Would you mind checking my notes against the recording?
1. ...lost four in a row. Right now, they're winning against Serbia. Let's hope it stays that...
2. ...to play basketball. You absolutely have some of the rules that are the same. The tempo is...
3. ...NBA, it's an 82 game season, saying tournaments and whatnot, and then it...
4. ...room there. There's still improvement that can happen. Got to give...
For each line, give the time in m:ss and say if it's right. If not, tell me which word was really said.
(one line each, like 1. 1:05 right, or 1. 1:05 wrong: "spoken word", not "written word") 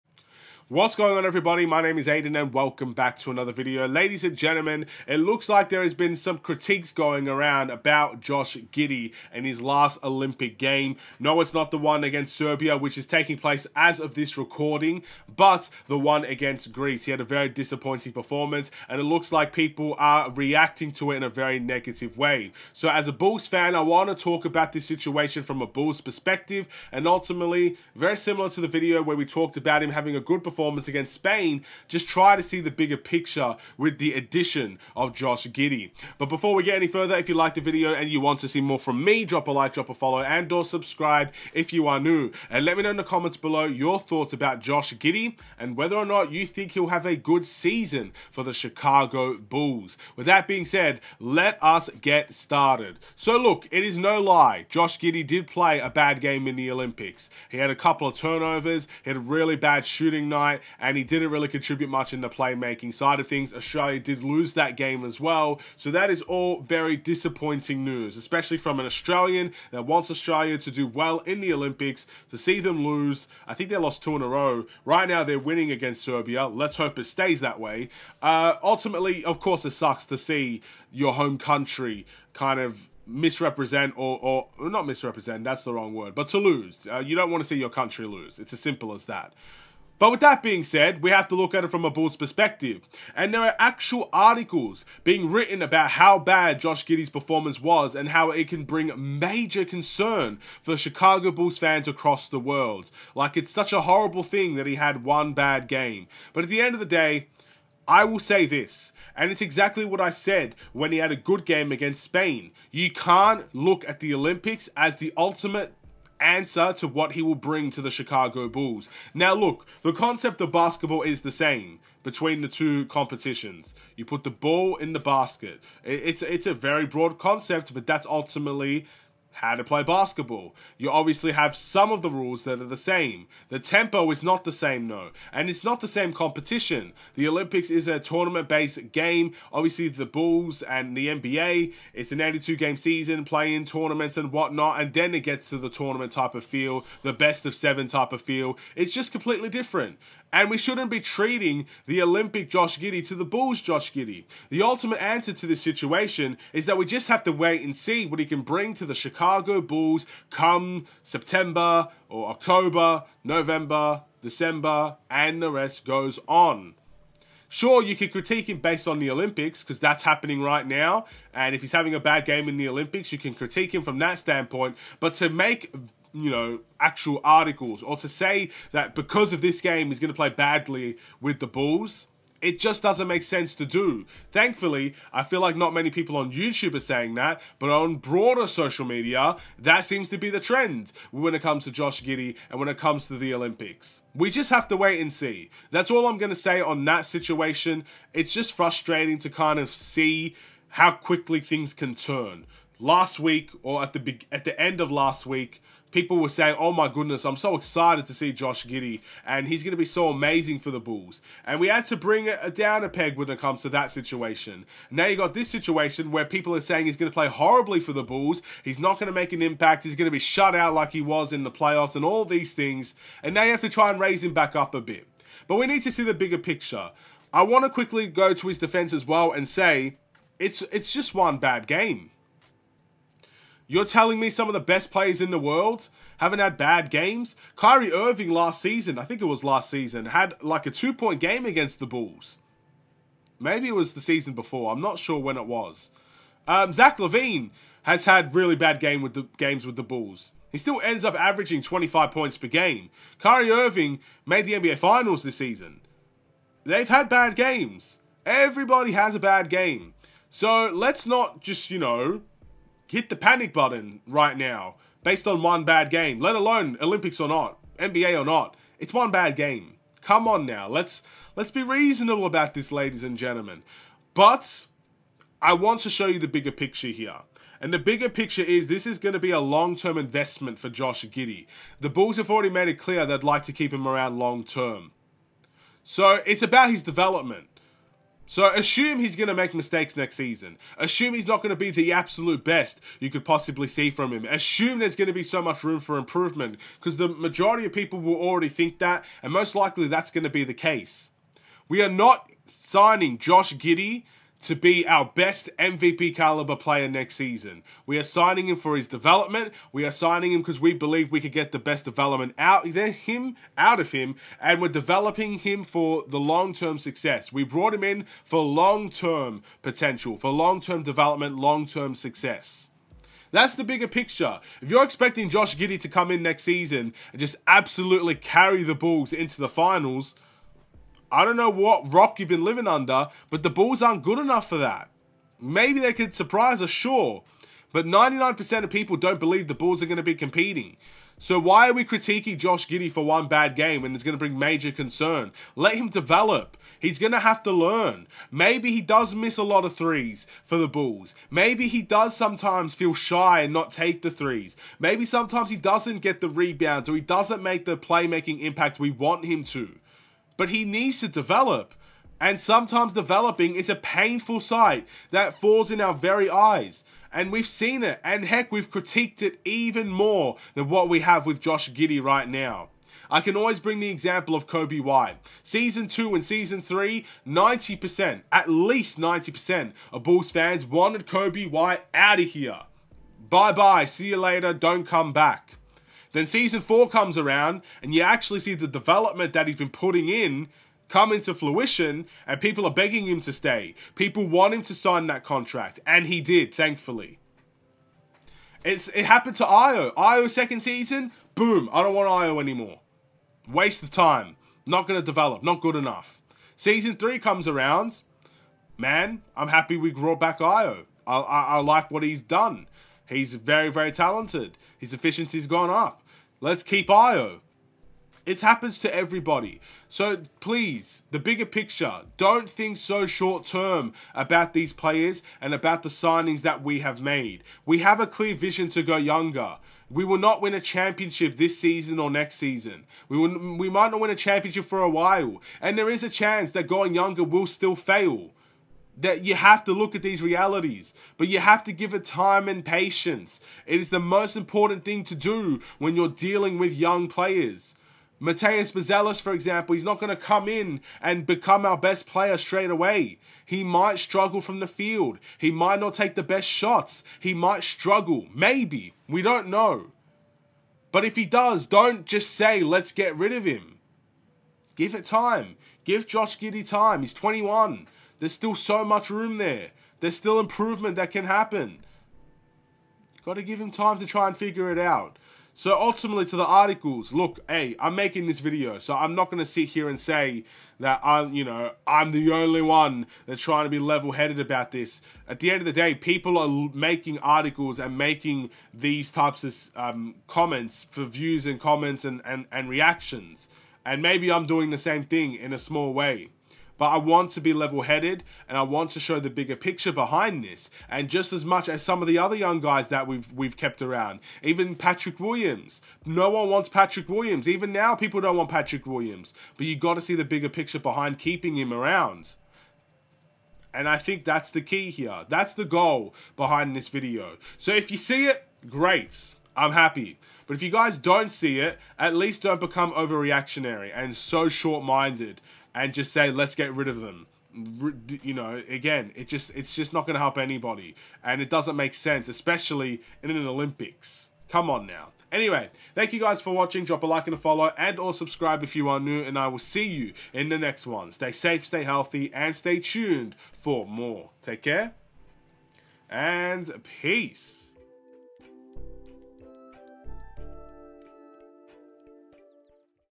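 1. 1:13 wrong: "two", not "four"
2. 2:09 wrong: "obviously", not "absolutely"
3. 2:21 wrong: "playing", not "saying"
4. 7:49 right.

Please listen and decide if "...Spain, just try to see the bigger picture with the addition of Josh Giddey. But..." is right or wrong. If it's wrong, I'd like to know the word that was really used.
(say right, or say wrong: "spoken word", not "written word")
right.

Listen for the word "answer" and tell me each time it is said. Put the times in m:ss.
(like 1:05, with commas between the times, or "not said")
1:56, 2:35.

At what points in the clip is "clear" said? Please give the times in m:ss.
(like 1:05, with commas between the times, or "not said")
4:42, 7:08.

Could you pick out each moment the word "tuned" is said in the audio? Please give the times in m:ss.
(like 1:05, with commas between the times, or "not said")
9:02.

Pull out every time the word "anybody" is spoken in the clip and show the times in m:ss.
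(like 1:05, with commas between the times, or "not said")
8:50.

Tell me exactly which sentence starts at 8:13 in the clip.
And maybe I'm doing the same thing in a small way.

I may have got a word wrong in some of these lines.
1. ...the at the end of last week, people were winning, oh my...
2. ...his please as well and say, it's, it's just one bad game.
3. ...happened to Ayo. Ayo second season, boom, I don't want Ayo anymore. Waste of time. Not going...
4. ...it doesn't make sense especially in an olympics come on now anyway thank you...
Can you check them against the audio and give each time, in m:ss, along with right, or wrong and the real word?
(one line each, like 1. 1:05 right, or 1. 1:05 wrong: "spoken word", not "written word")
1. 3:23 wrong: "saying", not "winning"
2. 3:48 wrong: "defense", not "please"
3. 6:39 right
4. 8:51 right.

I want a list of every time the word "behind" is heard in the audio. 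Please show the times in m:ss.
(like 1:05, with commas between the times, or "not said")
8:19, 8:30, 8:36.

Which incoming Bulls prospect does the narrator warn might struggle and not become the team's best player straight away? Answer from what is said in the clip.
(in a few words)
Matas Buzelis.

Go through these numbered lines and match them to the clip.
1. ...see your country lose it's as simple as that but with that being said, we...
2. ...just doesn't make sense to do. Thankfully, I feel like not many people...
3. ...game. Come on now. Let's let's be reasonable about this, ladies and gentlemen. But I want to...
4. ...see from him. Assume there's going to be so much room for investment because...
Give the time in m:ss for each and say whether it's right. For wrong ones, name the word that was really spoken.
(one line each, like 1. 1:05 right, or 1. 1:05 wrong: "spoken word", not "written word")
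1. 1:27 right
2. 3:02 right
3. 4:29 right
4. 4:53 wrong: "improvement", not "investment".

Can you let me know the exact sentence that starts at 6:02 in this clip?
And sometimes developing is a painful sight that falls in our very eyes.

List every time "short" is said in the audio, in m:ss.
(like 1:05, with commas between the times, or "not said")
7:03, 8:44.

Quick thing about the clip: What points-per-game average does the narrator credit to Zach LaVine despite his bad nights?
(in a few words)
25.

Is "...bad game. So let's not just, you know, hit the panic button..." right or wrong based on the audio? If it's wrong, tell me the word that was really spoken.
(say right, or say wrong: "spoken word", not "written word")
right.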